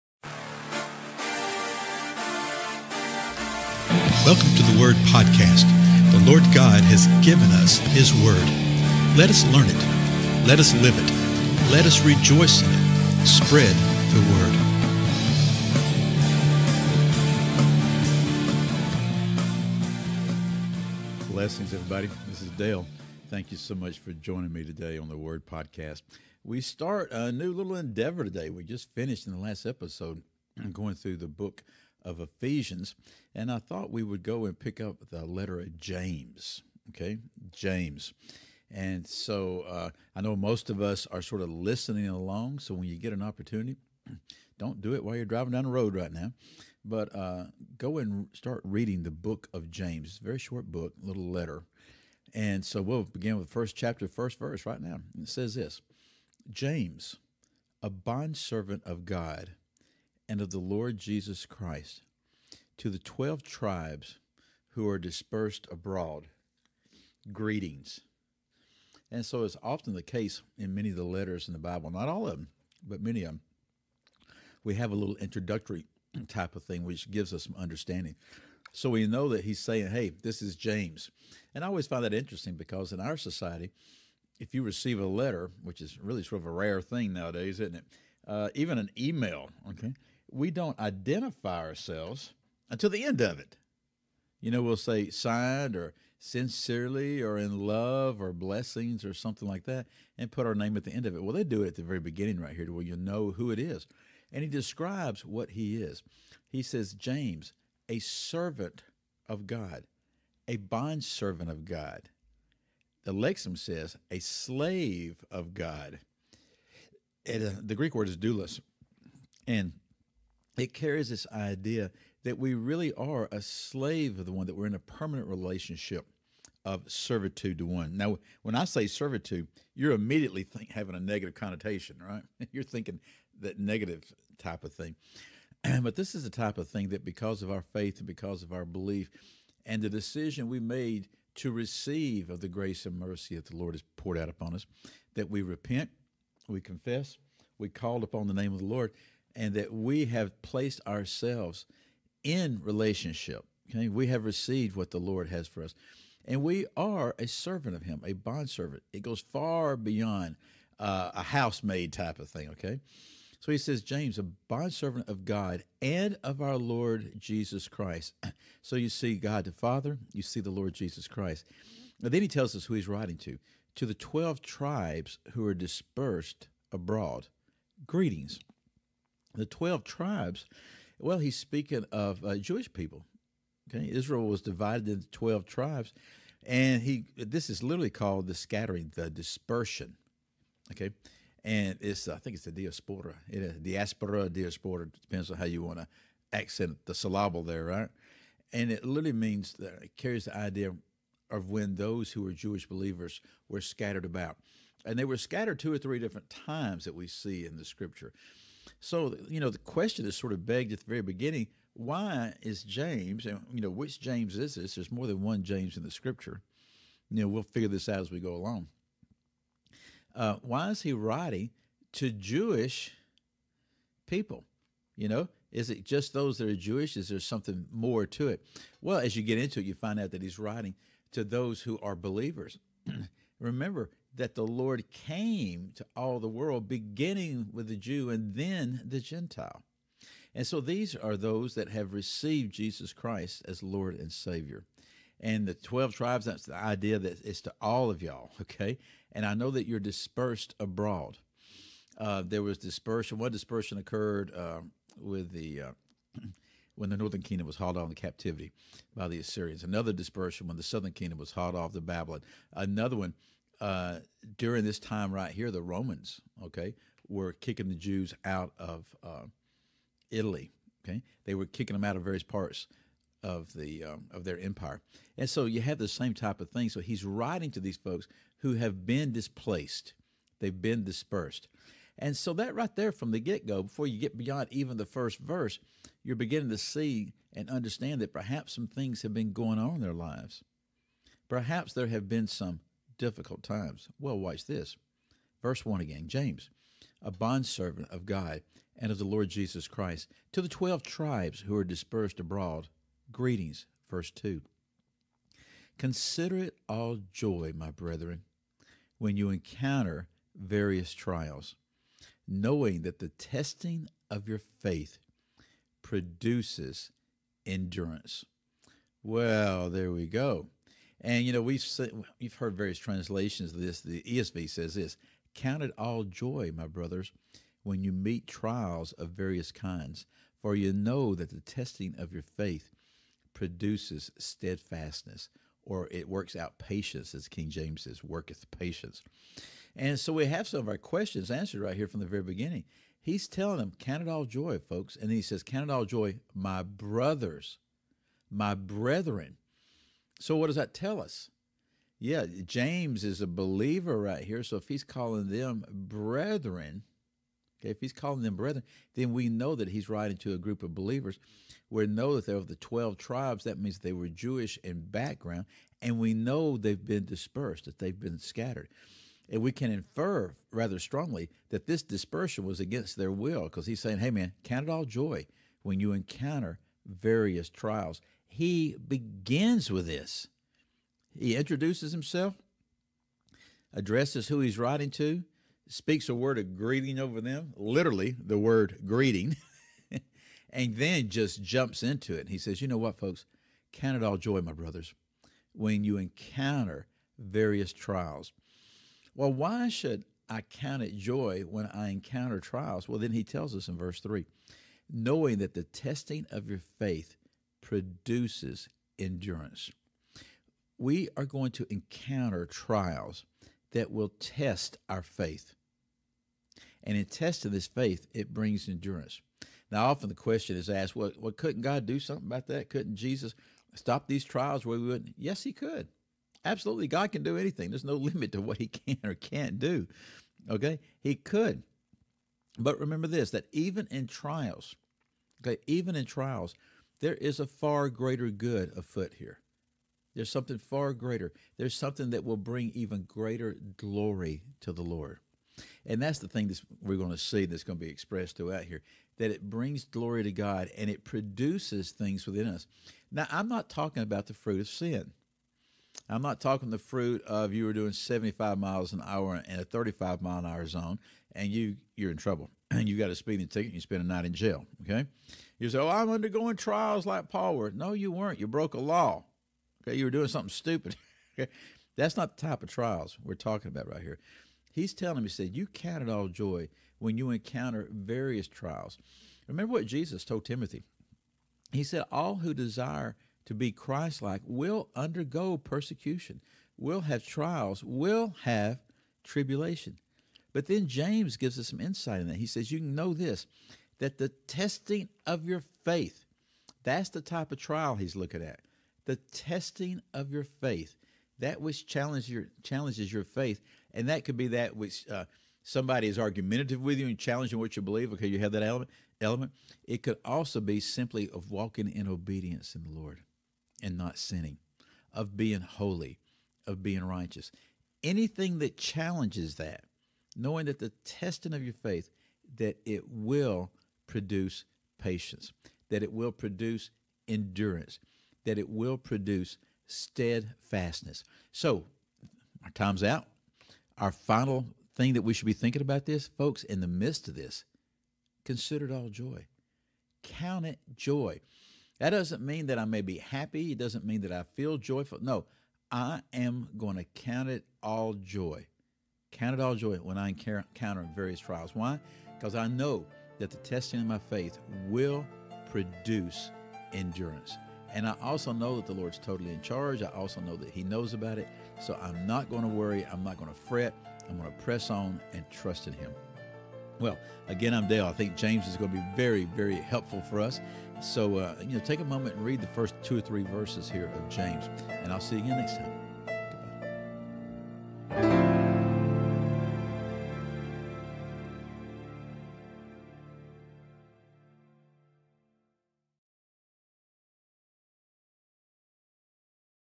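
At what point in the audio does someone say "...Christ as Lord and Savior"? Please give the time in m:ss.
4:02.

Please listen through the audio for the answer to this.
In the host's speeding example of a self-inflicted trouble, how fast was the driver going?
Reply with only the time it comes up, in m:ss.
7:37.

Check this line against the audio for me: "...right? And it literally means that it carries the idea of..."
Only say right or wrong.
right.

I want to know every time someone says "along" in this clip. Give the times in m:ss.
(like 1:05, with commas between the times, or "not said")
0:42, 3:38.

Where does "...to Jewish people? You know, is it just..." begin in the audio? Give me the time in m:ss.
3:41.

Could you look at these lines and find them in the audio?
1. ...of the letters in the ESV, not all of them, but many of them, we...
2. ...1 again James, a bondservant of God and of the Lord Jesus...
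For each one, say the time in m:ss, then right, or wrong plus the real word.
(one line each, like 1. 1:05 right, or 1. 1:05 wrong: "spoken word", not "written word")
1. 1:10 wrong: "Bible", not "ESV"
2. 4:55 right.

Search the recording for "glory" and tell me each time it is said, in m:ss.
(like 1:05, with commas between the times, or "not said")
7:23, 7:29.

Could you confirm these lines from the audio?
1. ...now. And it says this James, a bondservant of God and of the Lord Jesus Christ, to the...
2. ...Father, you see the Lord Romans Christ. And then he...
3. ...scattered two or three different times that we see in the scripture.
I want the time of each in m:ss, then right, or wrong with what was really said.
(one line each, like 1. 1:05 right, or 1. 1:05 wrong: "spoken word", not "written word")
1. 0:54 right
2. 2:49 wrong: "Jesus", not "Romans"
3. 3:25 right.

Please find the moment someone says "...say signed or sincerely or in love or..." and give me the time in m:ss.
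1:34.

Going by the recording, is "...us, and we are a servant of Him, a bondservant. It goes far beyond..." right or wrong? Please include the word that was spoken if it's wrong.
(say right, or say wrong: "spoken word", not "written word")
right.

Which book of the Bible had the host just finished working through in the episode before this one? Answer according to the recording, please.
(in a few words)
Ephesians.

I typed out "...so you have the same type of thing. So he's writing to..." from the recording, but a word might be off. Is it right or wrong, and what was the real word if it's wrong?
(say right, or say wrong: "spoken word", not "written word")
right.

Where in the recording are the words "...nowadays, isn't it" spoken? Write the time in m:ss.
1:27.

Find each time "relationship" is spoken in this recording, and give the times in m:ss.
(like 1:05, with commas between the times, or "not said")
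2:05, 2:32.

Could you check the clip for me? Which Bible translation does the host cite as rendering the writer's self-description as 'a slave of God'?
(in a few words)
Lexham.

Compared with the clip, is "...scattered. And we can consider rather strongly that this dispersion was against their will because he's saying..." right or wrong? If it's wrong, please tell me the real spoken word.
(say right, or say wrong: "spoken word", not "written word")
wrong: "infer", not "consider".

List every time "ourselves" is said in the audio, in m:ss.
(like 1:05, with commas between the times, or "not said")
1:31, 2:30.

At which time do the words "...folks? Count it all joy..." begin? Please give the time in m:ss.
6:32.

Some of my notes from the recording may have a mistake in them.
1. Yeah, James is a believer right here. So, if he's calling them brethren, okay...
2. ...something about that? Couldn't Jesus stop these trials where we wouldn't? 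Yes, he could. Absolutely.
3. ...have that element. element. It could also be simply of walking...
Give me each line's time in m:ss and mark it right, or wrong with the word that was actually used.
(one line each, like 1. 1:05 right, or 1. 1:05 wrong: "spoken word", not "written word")
1. 5:51 right
2. 7:02 right
3. 8:28 right.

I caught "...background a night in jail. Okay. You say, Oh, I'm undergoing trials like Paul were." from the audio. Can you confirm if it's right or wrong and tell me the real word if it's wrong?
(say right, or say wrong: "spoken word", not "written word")
wrong: "spend", not "background".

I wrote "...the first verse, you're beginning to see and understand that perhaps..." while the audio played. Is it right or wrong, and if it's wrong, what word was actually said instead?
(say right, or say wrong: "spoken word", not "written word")
right.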